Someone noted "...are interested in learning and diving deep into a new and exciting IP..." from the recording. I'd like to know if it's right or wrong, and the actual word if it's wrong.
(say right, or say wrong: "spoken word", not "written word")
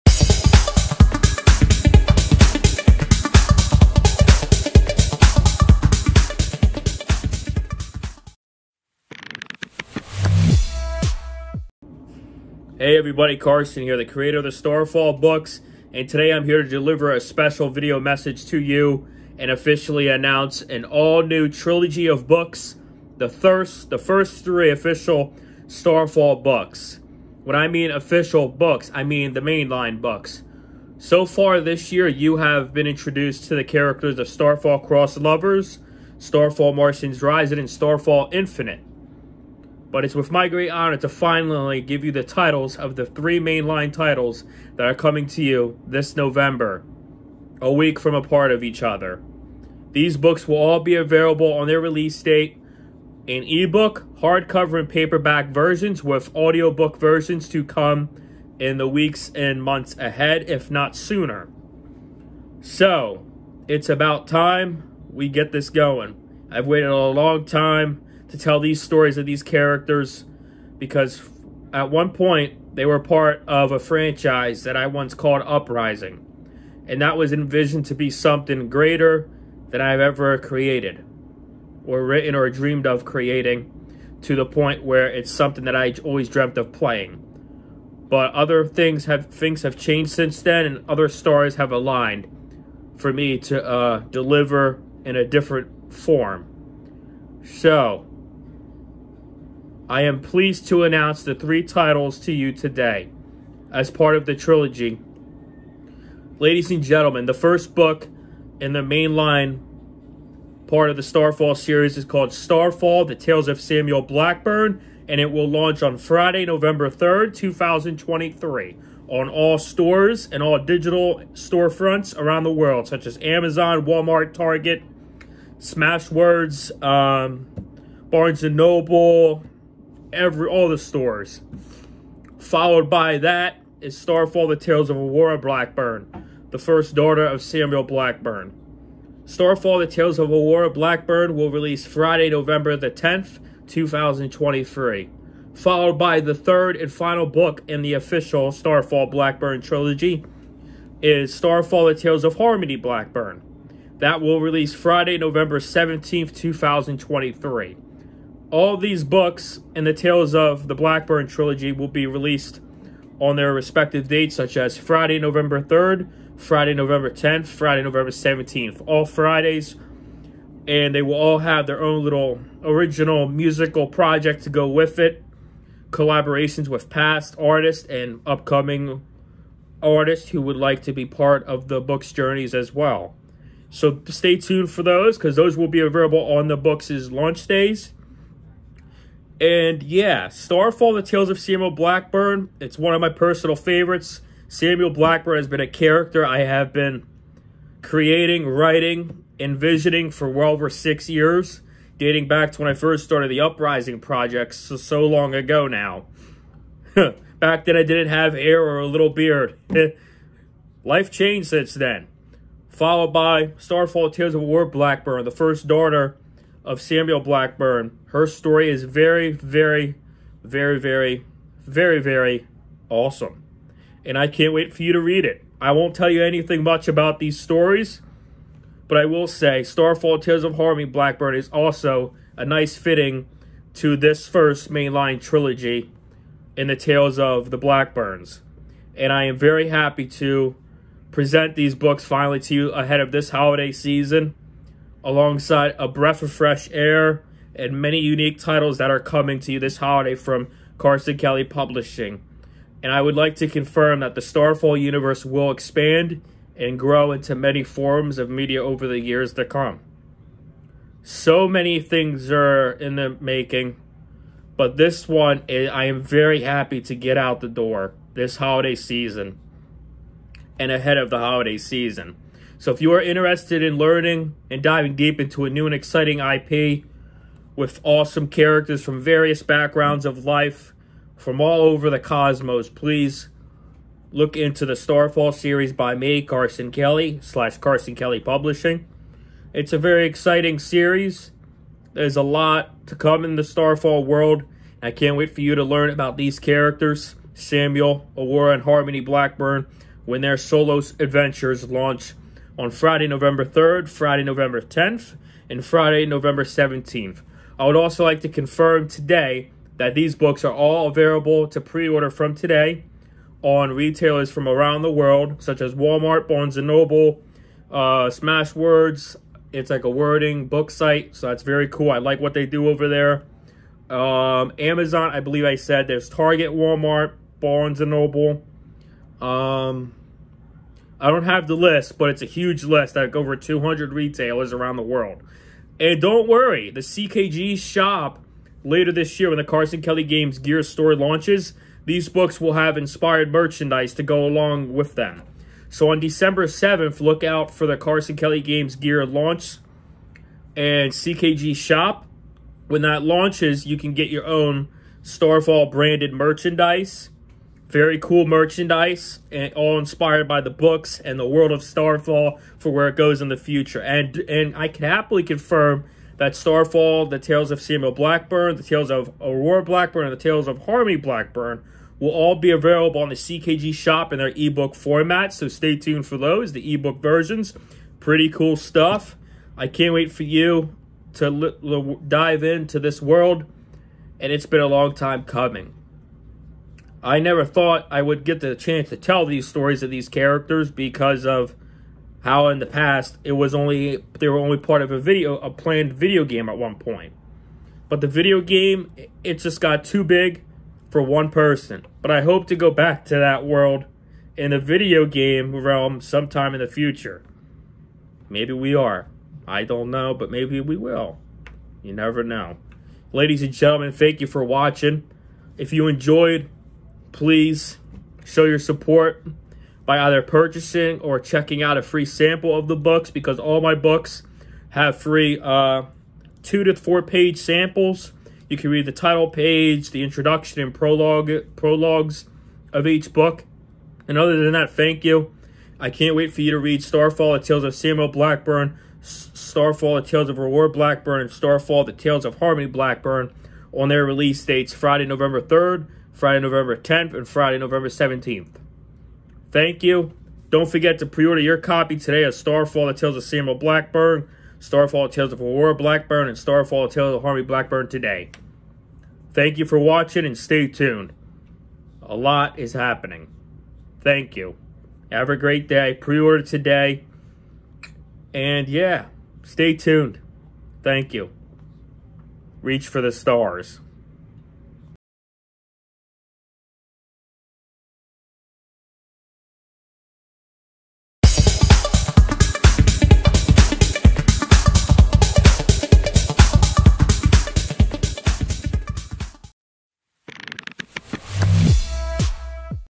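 right.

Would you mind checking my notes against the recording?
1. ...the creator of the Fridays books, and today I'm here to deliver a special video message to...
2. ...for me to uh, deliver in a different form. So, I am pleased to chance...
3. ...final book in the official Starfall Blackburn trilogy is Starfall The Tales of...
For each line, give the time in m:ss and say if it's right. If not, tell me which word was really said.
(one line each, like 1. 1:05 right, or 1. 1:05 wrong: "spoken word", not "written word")
1. 0:13 wrong: "Starfall", not "Fridays"
2. 1:32 wrong: "announce", not "chance"
3. 2:26 right.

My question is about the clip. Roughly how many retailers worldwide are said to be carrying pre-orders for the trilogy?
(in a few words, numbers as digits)
over 200.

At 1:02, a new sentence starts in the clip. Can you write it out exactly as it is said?
So, it's about time we get this going.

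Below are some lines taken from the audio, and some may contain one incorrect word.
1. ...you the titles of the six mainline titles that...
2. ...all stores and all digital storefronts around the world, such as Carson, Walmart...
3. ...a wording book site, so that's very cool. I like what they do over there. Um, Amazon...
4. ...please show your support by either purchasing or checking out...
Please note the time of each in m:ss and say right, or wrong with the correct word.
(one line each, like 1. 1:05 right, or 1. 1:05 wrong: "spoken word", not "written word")
1. 0:42 wrong: "three", not "six"
2. 1:59 wrong: "Amazon", not "Carson"
3. 5:19 right
4. 6:57 right.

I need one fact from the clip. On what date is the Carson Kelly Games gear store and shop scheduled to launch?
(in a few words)
December 7th.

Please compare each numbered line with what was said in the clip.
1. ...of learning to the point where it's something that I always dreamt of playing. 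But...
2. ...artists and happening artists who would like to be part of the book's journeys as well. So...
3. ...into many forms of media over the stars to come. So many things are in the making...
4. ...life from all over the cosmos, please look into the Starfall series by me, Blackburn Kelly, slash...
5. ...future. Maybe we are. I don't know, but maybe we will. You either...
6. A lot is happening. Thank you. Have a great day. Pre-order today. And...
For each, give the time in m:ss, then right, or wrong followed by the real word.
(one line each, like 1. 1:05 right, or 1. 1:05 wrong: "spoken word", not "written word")
1. 1:22 wrong: "creating", not "learning"
2. 2:57 wrong: "upcoming", not "happening"
3. 4:17 wrong: "years", not "stars"
4. 4:40 wrong: "Carson", not "Blackburn"
5. 6:46 wrong: "never", not "either"
6. 7:42 right.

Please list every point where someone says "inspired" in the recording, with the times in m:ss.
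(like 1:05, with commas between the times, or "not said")
5:42, 5:59.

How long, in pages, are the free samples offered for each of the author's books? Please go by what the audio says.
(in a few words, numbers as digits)
2 to 4 pages.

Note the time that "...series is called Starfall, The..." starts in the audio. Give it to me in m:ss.
1:51.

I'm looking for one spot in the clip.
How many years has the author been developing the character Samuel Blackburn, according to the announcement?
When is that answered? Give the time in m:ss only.
3:20.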